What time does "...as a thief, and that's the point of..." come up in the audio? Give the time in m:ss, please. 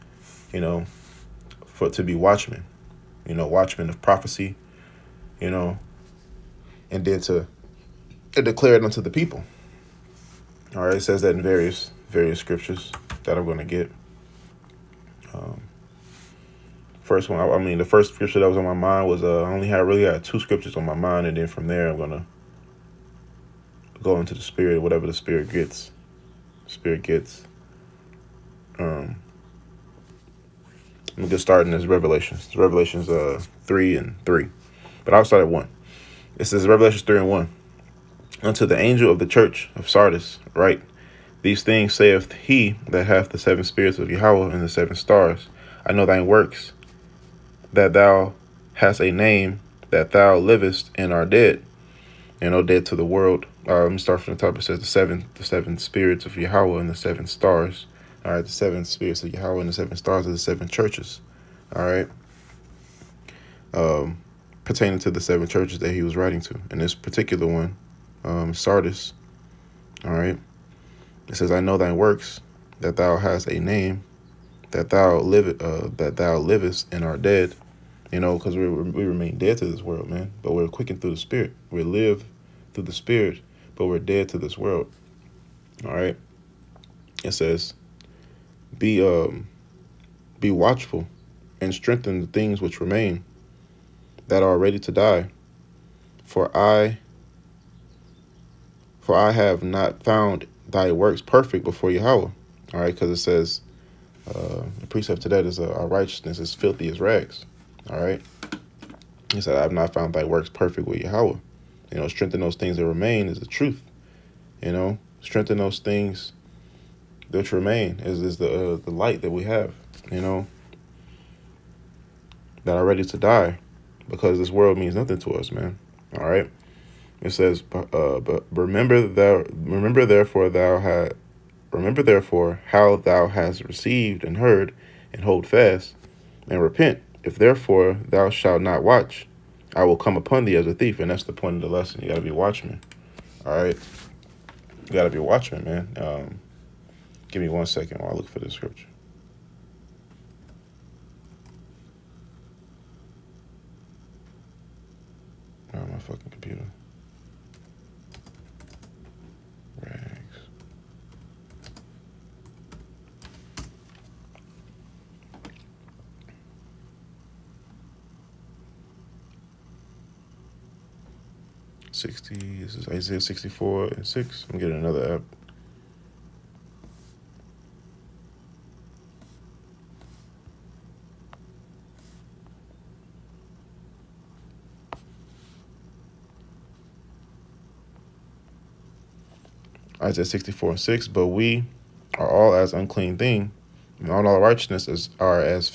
2:20.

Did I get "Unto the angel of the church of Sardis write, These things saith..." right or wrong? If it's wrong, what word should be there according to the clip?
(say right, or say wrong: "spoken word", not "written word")
right.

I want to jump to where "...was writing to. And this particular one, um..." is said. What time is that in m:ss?
1:06.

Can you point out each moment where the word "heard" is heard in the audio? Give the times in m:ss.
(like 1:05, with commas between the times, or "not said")
2:14.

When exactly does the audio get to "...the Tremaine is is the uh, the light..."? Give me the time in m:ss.
1:57.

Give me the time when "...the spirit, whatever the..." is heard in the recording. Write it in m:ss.
0:24.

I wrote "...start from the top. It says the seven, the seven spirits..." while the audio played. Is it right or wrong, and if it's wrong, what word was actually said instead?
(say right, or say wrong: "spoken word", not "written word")
right.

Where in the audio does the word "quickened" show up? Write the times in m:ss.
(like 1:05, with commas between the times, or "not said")
1:20.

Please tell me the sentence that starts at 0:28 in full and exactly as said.
Um, I'm just starting this Revelations.